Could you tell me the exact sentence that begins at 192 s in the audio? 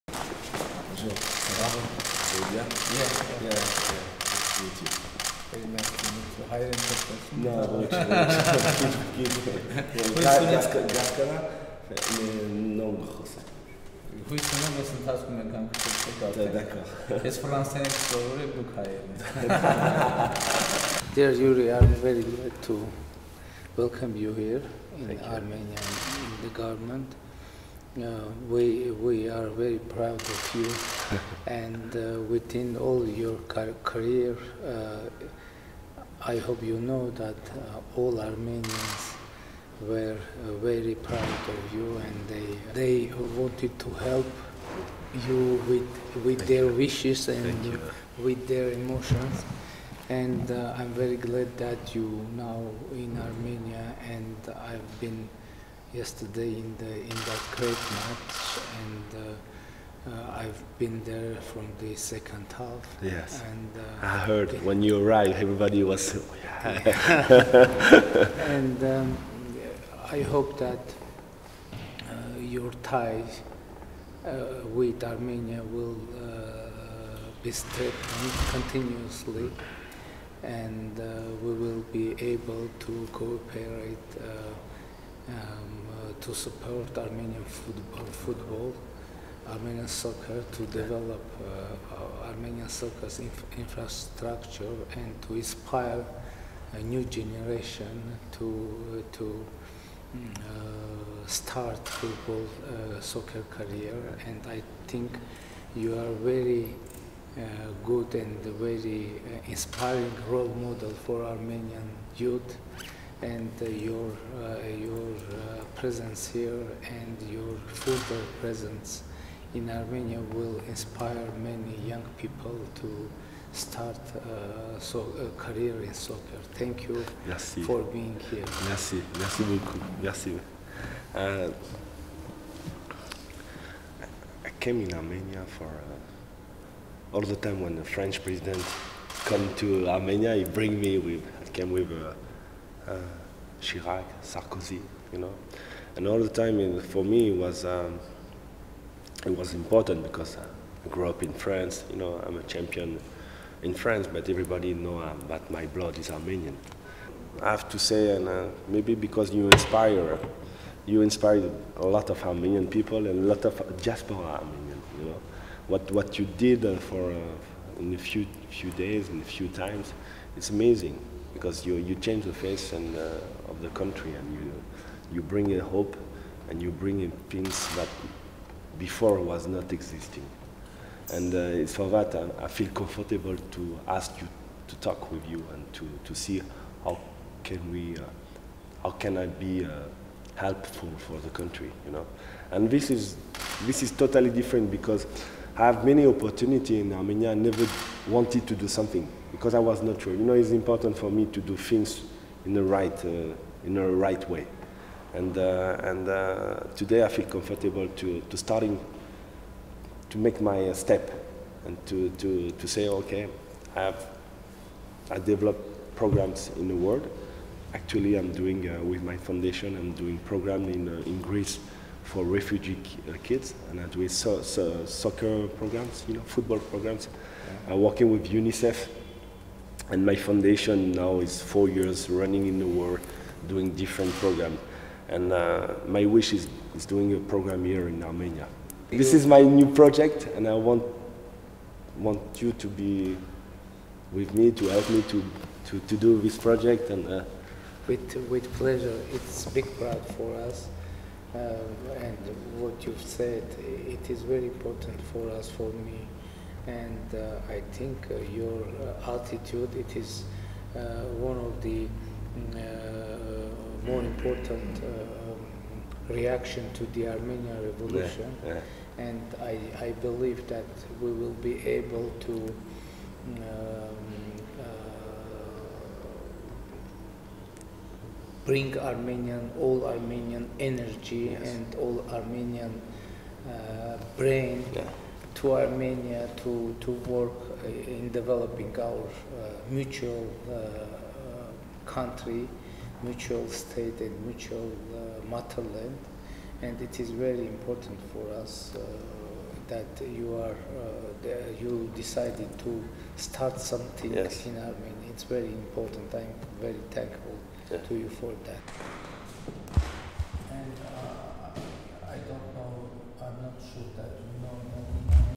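And this is, this is totally different because I have many opportunities in Armenia.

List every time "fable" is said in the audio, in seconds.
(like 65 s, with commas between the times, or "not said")
not said.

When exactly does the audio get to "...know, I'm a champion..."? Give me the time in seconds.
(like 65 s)
151 s.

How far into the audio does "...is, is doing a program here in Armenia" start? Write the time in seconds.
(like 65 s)
236 s.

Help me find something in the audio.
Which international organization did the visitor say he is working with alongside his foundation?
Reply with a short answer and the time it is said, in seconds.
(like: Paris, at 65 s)
UNICEF, at 228 s.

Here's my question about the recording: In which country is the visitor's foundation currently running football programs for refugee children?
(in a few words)
Greece.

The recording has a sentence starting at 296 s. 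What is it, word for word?
And it is very important for us that you are you decided to start something yes.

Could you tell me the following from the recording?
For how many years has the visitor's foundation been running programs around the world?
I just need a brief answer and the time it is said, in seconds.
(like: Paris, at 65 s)
4, at 231 s.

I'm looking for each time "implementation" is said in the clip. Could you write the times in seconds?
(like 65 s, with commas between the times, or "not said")
not said.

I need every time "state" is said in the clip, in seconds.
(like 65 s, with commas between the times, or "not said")
293 s.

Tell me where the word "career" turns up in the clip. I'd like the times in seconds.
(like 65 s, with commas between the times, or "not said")
33 s, 103 s, 125 s.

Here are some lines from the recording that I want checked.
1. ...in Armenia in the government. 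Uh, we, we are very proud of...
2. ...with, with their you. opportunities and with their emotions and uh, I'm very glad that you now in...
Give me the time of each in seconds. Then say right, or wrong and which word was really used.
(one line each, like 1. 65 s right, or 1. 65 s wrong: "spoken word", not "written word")
1. 24 s right
2. 45 s wrong: "wishes", not "opportunities".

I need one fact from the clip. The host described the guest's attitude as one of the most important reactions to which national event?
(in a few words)
Armenian Revolution.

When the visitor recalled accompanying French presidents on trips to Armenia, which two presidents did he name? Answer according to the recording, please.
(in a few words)
Chirac, Sarkozy.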